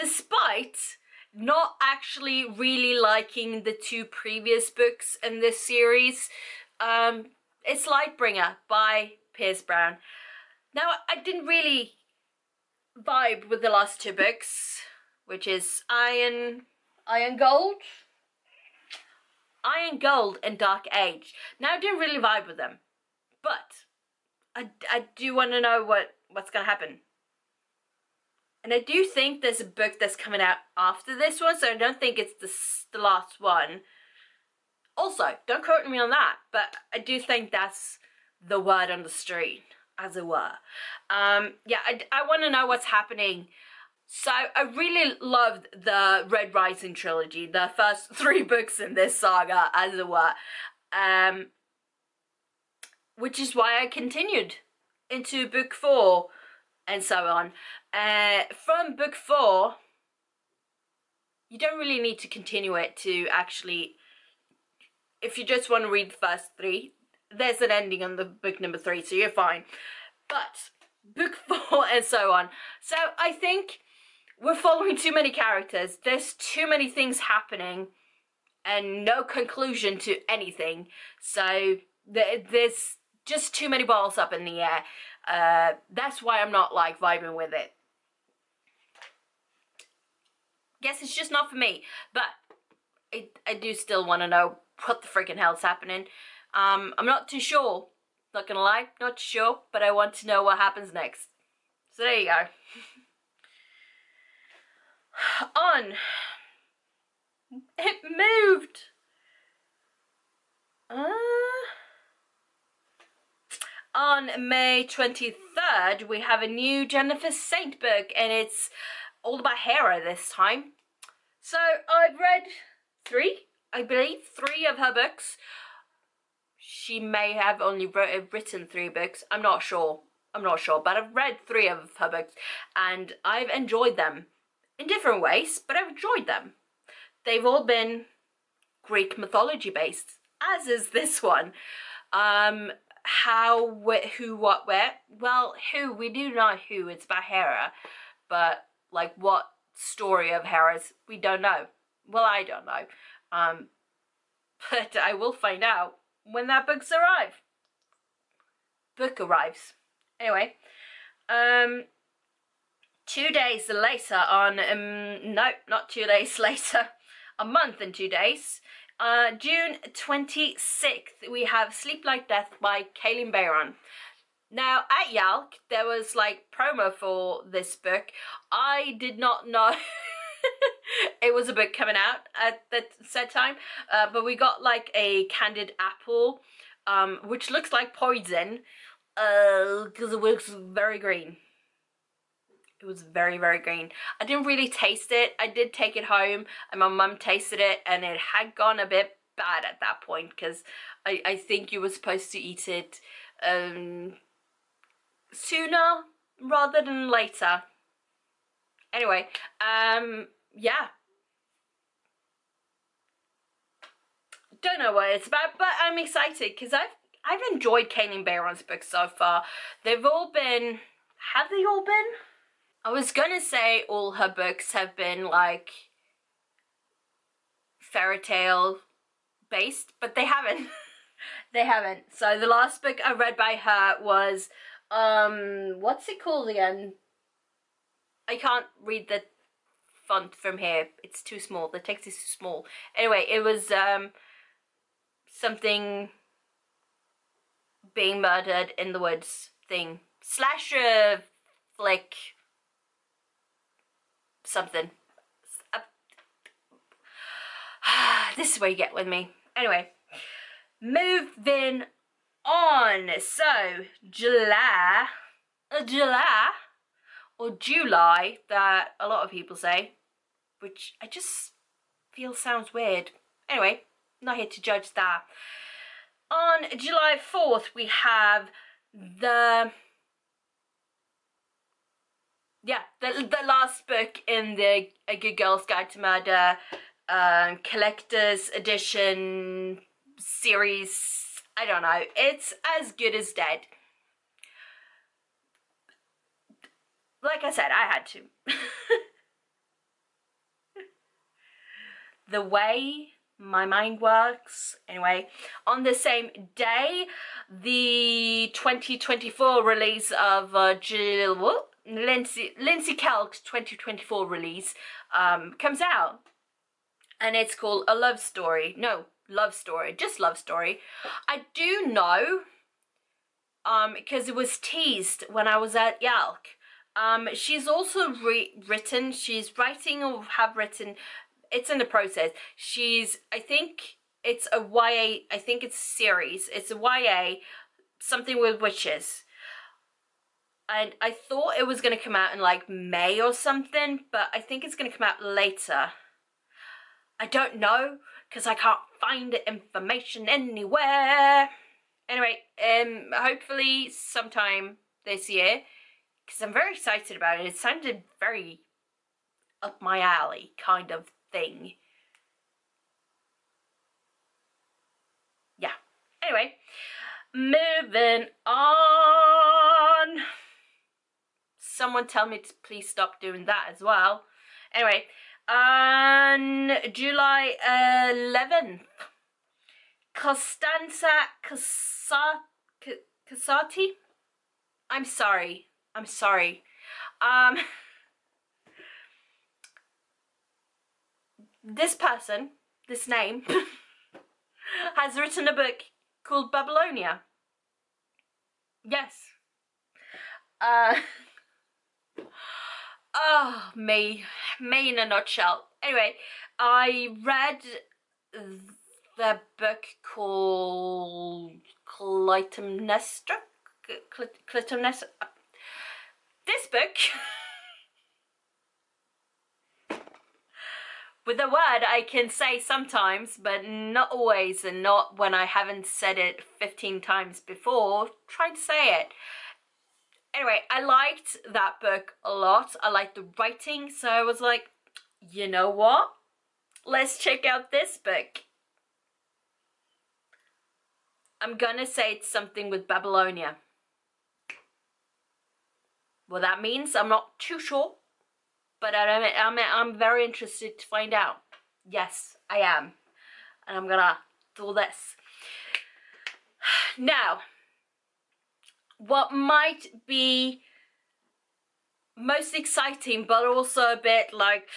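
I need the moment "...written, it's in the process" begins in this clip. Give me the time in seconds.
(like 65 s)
330 s.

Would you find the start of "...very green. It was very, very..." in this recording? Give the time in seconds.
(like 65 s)
190 s.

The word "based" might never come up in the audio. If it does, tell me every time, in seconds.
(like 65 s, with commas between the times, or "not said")
139 s, 229 s.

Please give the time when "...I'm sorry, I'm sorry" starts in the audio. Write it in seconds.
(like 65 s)
384 s.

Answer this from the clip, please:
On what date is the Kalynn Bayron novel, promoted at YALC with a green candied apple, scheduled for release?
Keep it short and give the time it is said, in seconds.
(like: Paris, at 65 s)
June 26th, at 169 s.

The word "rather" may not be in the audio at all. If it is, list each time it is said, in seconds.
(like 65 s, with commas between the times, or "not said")
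206 s.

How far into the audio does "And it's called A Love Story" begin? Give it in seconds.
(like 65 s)
317 s.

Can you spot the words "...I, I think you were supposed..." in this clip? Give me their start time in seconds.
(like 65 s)
201 s.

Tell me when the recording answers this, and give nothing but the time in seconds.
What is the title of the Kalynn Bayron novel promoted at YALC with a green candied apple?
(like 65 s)
171 s.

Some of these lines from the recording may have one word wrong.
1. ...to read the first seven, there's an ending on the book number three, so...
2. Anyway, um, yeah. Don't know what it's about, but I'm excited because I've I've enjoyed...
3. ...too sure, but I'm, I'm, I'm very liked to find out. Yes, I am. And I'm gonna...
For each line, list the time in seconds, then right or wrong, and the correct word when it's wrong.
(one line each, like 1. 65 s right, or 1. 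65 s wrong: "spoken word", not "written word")
1. 65 s wrong: "three", not "seven"
2. 208 s right
3. 447 s wrong: "interested", not "liked".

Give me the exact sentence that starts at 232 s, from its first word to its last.
So the last book I read by her was um what's it called again?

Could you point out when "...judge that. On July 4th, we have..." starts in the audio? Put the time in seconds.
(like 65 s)
274 s.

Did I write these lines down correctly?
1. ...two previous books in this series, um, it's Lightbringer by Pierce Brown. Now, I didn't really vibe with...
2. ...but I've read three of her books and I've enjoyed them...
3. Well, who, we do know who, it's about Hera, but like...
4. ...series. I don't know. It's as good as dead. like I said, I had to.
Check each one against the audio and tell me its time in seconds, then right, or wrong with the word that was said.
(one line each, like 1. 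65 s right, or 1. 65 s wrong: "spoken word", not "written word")
1. 3 s right
2. 130 s right
3. 145 s right
4. 290 s right.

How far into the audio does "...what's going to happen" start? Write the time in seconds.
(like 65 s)
26 s.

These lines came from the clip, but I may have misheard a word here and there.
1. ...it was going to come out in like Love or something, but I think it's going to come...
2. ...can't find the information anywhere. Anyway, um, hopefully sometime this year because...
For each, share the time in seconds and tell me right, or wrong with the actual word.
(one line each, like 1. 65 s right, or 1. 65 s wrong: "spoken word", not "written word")
1. 341 s wrong: "May", not "Love"
2. 348 s right.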